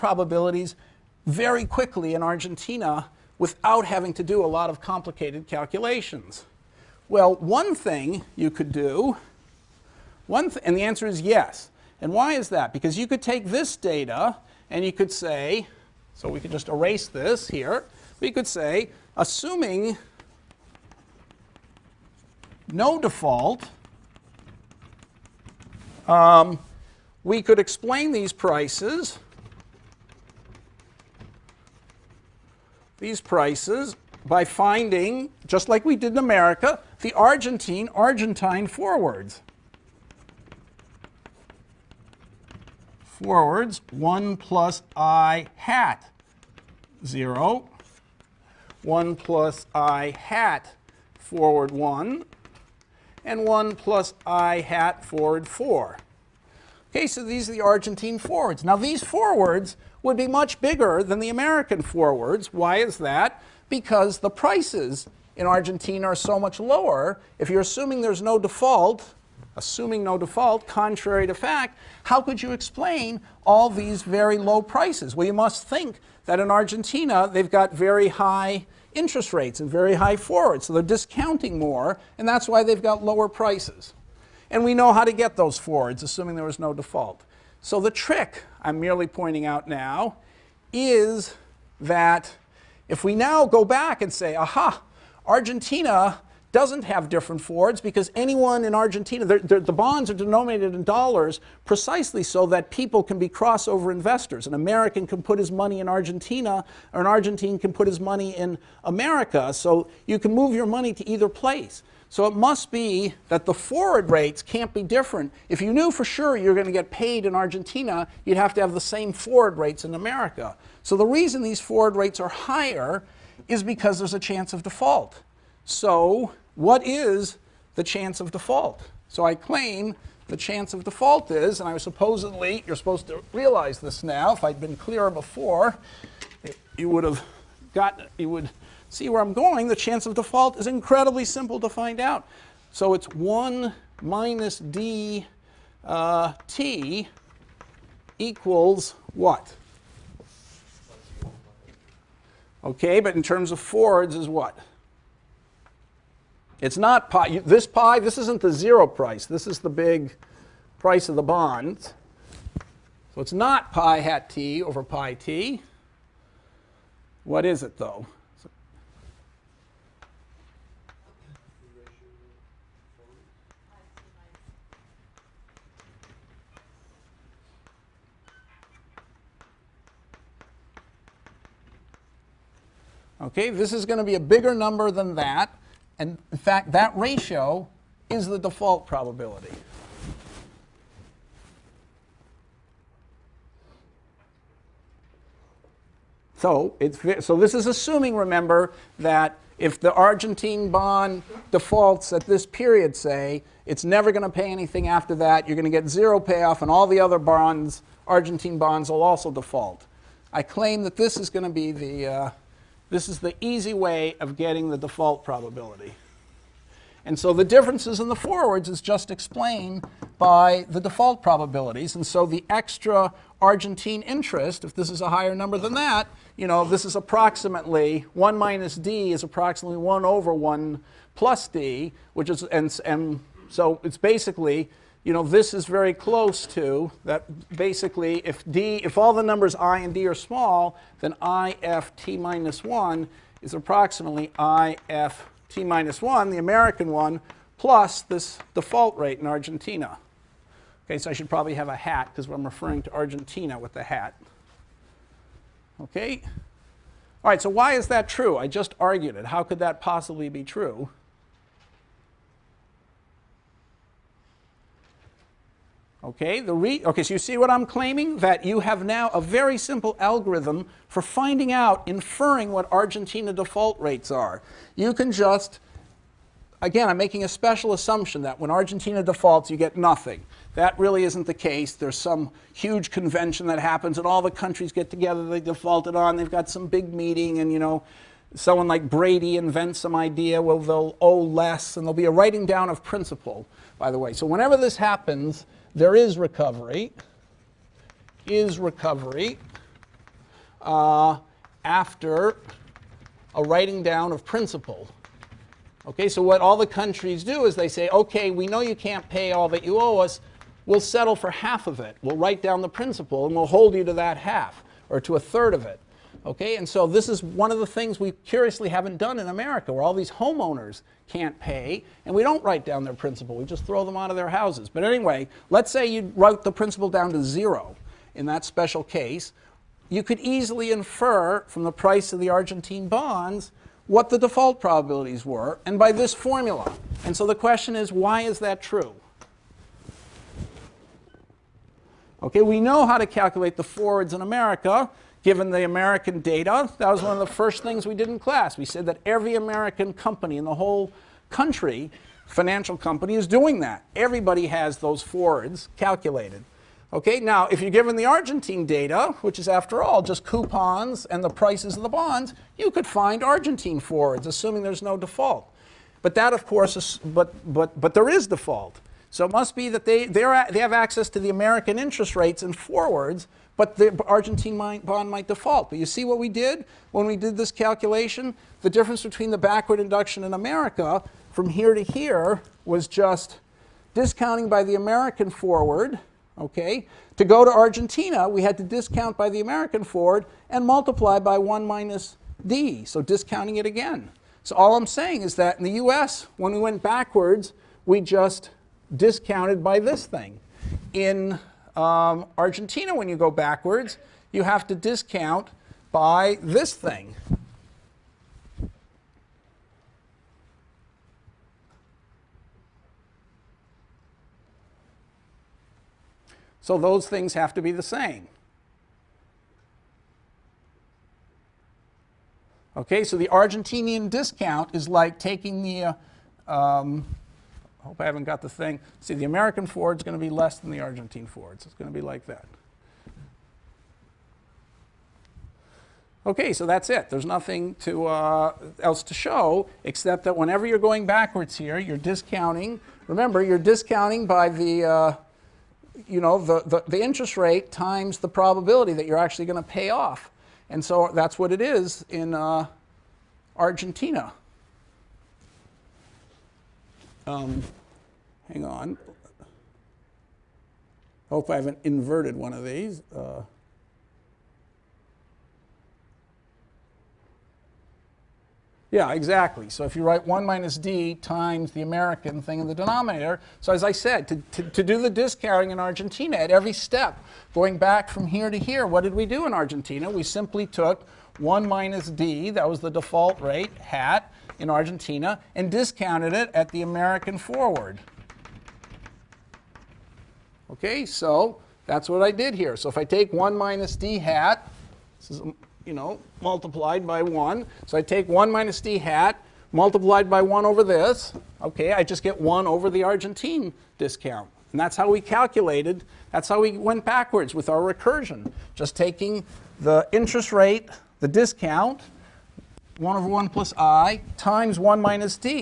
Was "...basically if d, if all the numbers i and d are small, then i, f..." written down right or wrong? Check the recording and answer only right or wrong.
right.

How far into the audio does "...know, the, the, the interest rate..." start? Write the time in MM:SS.
07:26.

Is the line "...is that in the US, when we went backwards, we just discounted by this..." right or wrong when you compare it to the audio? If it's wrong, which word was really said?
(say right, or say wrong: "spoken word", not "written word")
right.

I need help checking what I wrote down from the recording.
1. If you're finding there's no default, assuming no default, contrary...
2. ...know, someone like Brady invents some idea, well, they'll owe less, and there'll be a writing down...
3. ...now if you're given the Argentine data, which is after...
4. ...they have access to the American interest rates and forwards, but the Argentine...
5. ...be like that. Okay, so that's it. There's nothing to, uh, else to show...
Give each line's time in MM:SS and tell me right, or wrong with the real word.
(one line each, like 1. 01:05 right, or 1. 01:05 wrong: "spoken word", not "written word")
1. 01:07 wrong: "assuming", not "finding"
2. 04:47 right
3. 05:57 right
4. 06:10 right
5. 07:11 right.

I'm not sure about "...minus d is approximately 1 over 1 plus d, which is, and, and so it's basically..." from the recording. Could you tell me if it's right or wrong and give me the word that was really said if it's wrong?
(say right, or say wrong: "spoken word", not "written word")
right.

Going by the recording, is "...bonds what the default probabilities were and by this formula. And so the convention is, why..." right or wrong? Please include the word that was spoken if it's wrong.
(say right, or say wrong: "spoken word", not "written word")
wrong: "question", not "convention".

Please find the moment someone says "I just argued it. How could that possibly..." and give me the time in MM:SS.
04:18.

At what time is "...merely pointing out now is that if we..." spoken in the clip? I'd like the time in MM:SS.
01:28.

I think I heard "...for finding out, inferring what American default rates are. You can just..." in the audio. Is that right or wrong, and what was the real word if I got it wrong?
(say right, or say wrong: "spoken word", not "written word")
wrong: "Argentina", not "American".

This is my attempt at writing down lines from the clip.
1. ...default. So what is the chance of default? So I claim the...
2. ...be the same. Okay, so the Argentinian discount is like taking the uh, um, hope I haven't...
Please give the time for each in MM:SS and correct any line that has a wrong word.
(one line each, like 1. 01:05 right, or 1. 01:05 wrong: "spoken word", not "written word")
1. 02:04 right
2. 06:57 right.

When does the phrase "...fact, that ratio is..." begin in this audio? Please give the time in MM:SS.
03:06.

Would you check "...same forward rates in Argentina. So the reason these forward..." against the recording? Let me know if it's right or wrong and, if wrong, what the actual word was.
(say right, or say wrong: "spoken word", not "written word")
wrong: "America", not "Argentina".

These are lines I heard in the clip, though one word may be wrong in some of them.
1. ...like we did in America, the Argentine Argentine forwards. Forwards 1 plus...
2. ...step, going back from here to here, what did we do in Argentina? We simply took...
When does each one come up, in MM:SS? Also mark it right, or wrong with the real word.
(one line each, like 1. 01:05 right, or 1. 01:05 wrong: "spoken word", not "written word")
1. 00:35 right
2. 07:56 right.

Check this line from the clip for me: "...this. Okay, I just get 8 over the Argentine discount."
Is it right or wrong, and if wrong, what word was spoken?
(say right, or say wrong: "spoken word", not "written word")
wrong: "1", not "8".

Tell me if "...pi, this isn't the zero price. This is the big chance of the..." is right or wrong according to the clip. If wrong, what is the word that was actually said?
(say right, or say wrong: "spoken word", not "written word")
wrong: "price", not "chance".